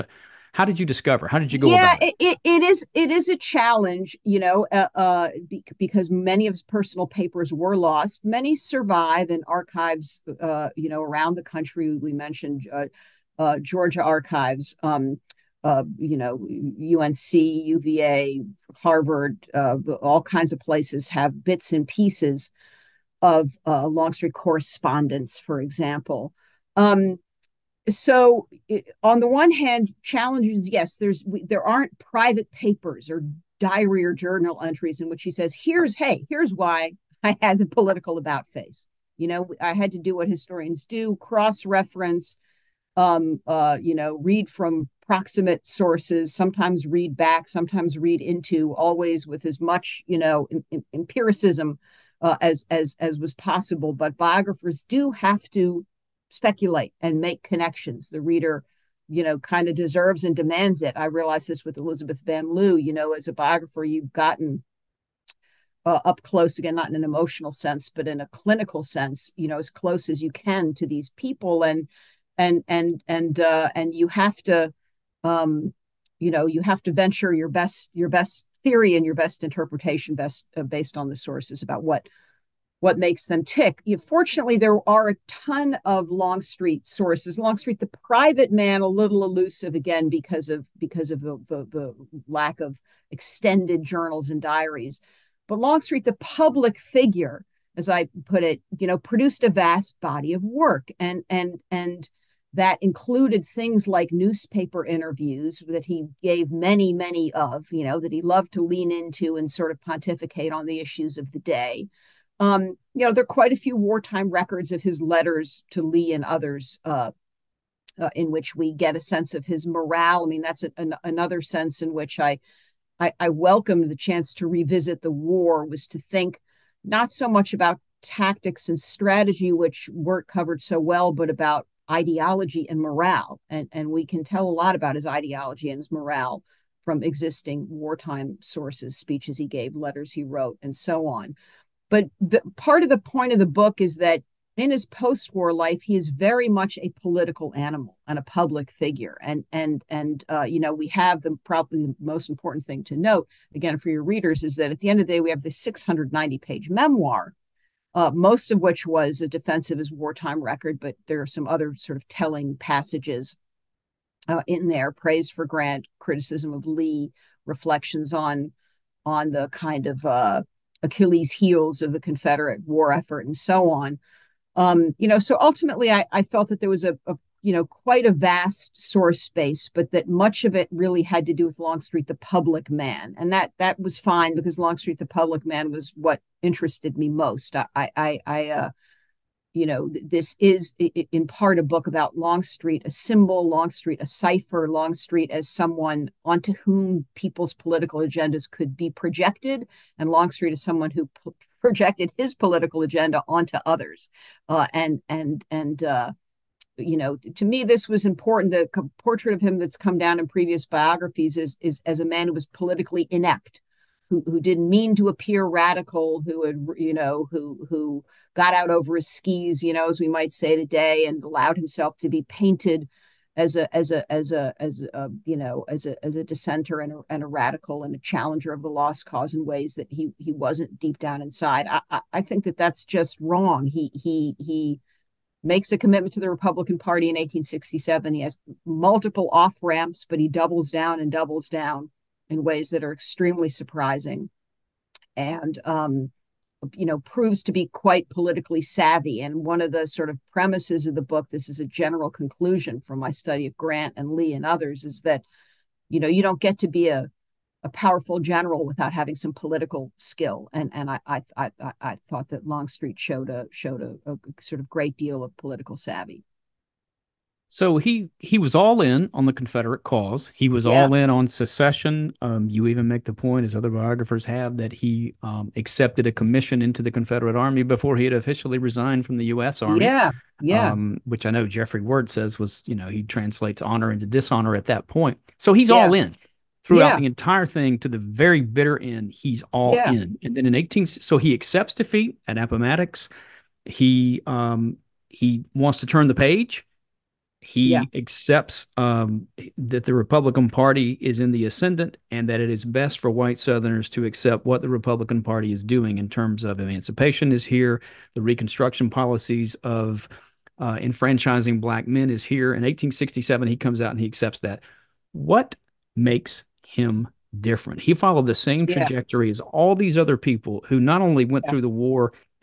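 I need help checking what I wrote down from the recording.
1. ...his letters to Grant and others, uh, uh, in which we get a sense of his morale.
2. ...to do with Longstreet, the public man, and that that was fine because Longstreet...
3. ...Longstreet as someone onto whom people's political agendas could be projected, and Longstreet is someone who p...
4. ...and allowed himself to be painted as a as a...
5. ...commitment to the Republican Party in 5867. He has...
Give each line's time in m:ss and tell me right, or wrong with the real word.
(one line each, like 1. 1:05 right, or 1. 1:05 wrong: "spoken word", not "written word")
1. 1:54 wrong: "Lee", not "Grant"
2. 3:01 right
3. 3:14 right
4. 3:41 right
5. 3:55 wrong: "1867", not "5867".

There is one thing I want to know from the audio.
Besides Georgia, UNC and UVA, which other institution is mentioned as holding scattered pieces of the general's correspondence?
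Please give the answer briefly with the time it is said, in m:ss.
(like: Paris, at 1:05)
Harvard, at 0:18.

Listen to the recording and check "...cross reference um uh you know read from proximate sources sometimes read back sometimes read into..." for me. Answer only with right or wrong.
right.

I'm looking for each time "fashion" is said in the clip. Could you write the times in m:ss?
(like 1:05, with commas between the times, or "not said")
not said.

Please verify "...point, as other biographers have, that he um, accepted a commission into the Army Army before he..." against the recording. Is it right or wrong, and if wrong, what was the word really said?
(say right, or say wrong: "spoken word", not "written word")
wrong: "Confederate", not "Army".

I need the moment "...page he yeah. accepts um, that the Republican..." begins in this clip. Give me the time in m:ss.
4:56.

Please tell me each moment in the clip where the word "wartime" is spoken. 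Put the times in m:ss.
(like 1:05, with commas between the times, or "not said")
1:53, 2:17, 2:39.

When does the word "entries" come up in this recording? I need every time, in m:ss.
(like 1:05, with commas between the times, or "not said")
0:34.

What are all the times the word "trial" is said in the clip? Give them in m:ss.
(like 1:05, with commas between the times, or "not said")
not said.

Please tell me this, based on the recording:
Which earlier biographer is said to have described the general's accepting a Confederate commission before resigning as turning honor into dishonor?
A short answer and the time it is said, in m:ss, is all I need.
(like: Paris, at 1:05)
Jeffry Wert, at 4:41.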